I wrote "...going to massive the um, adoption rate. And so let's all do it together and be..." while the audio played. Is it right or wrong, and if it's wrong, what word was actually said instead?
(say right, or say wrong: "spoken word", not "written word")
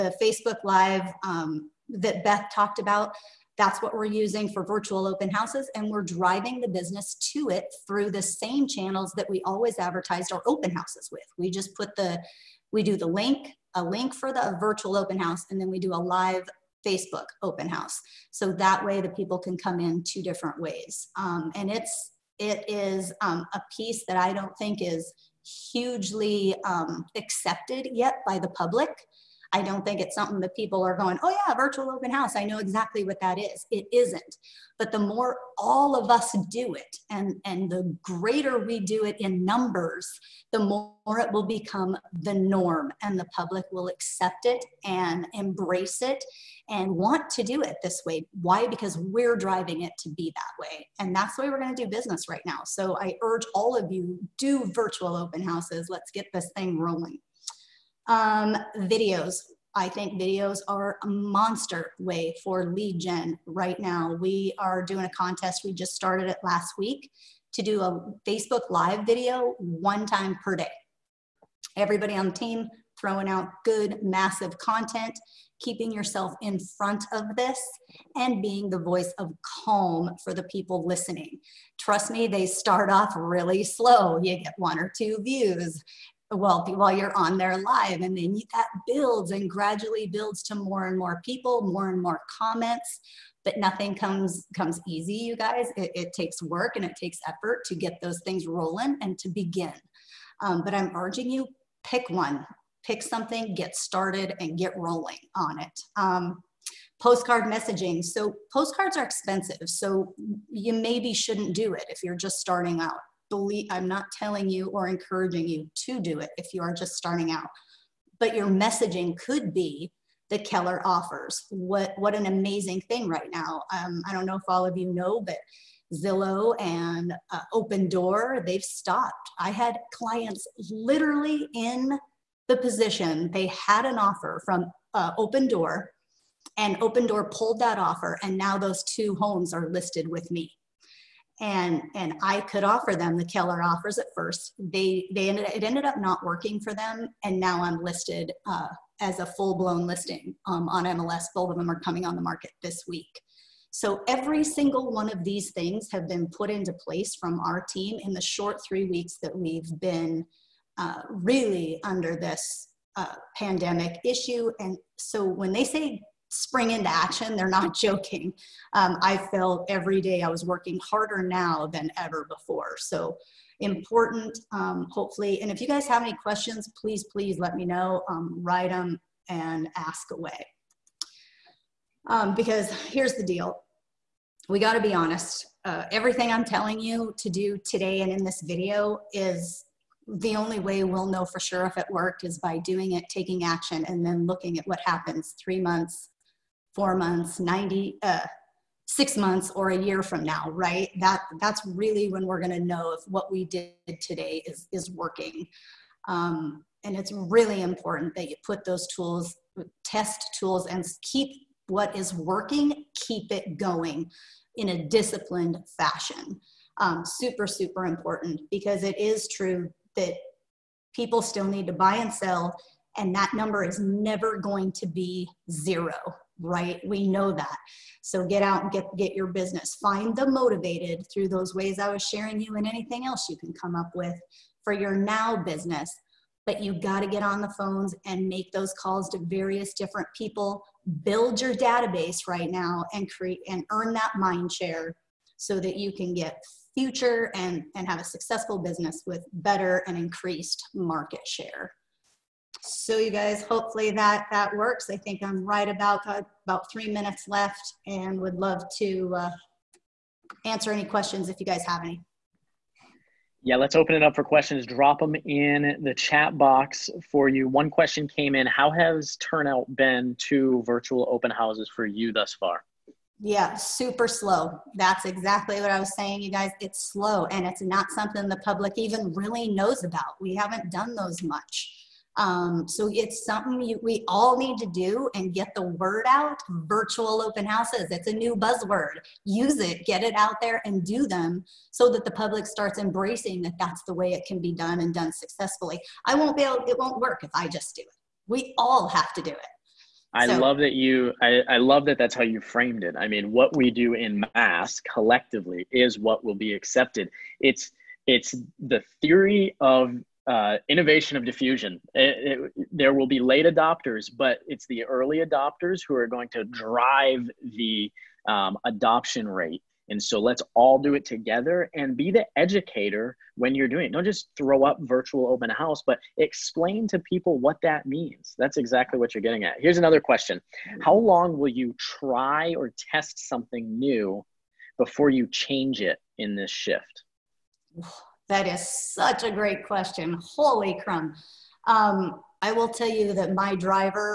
wrong: "drive", not "massive".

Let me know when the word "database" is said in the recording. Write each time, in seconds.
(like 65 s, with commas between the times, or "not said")
241 s.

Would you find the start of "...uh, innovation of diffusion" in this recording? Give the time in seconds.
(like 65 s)
310 s.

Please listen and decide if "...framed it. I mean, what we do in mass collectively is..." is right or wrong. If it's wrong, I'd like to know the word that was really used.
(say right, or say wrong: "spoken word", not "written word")
right.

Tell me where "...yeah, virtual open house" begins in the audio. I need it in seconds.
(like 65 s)
31 s.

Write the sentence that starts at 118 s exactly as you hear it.
But your messaging could be the Keller offers.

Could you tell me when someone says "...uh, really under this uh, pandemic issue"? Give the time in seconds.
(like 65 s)
160 s.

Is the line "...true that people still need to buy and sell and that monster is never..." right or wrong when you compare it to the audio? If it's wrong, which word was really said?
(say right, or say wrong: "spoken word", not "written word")
wrong: "number", not "monster".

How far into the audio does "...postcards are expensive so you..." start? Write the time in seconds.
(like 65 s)
108 s.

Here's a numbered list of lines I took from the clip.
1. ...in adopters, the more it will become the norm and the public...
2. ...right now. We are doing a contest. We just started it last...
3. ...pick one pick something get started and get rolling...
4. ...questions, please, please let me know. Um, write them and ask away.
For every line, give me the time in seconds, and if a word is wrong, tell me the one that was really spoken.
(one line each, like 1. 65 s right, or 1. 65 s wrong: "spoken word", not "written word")
1. 39 s wrong: "numbers", not "adopters"
2. 63 s right
3. 101 s right
4. 176 s right.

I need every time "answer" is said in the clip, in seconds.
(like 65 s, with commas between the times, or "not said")
260 s.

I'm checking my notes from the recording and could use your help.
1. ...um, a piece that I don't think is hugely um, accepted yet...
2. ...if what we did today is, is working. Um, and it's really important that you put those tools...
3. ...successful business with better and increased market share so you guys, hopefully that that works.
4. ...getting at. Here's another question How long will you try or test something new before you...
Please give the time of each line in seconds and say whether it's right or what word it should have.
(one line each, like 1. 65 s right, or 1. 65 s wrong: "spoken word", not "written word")
1. 23 s right
2. 202 s right
3. 248 s right
4. 329 s right.